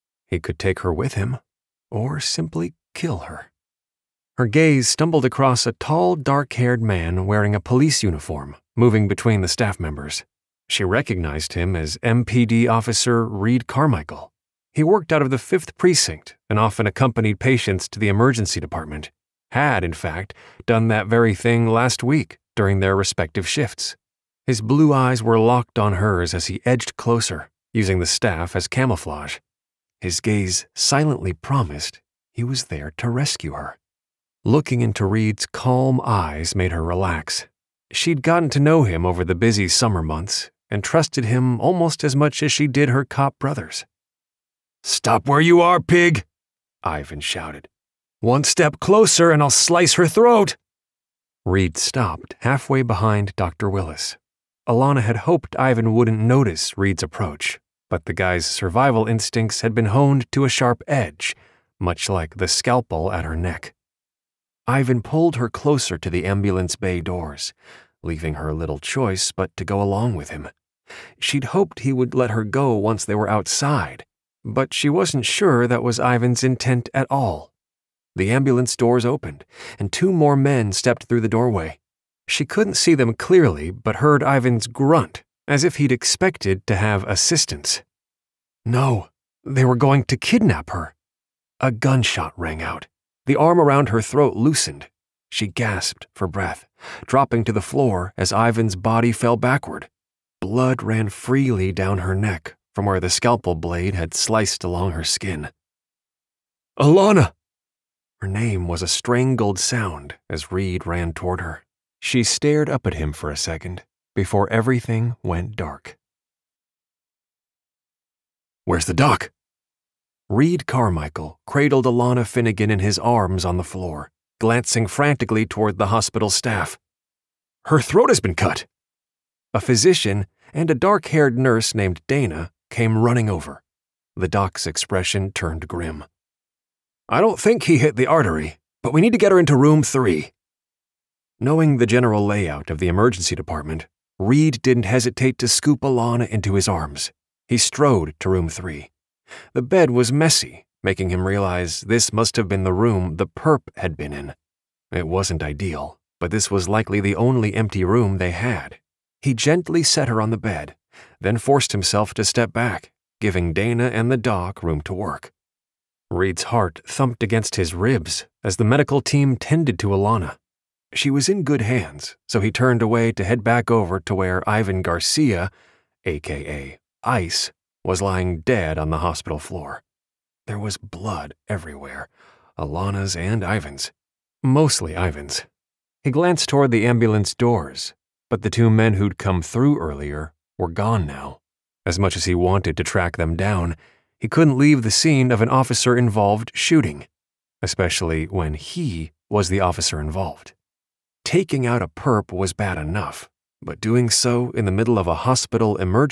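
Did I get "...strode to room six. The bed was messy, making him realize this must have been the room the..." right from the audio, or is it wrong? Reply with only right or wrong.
wrong.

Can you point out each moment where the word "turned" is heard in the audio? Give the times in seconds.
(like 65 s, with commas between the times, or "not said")
135 s, 172 s.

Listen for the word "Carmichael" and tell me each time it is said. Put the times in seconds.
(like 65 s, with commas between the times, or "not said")
13 s, 120 s.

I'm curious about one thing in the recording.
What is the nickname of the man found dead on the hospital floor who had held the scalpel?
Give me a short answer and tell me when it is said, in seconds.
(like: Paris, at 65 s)
Ice, at 177 s.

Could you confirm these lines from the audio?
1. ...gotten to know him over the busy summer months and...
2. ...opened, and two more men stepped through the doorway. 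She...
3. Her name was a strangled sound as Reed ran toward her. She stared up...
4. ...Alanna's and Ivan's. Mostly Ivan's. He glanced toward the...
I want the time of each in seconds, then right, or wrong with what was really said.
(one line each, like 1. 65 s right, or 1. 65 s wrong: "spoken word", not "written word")
1. 38 s right
2. 79 s right
3. 108 s right
4. 182 s right.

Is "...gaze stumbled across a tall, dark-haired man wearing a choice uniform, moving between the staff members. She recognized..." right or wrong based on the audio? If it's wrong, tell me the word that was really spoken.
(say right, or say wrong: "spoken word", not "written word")
wrong: "police", not "choice".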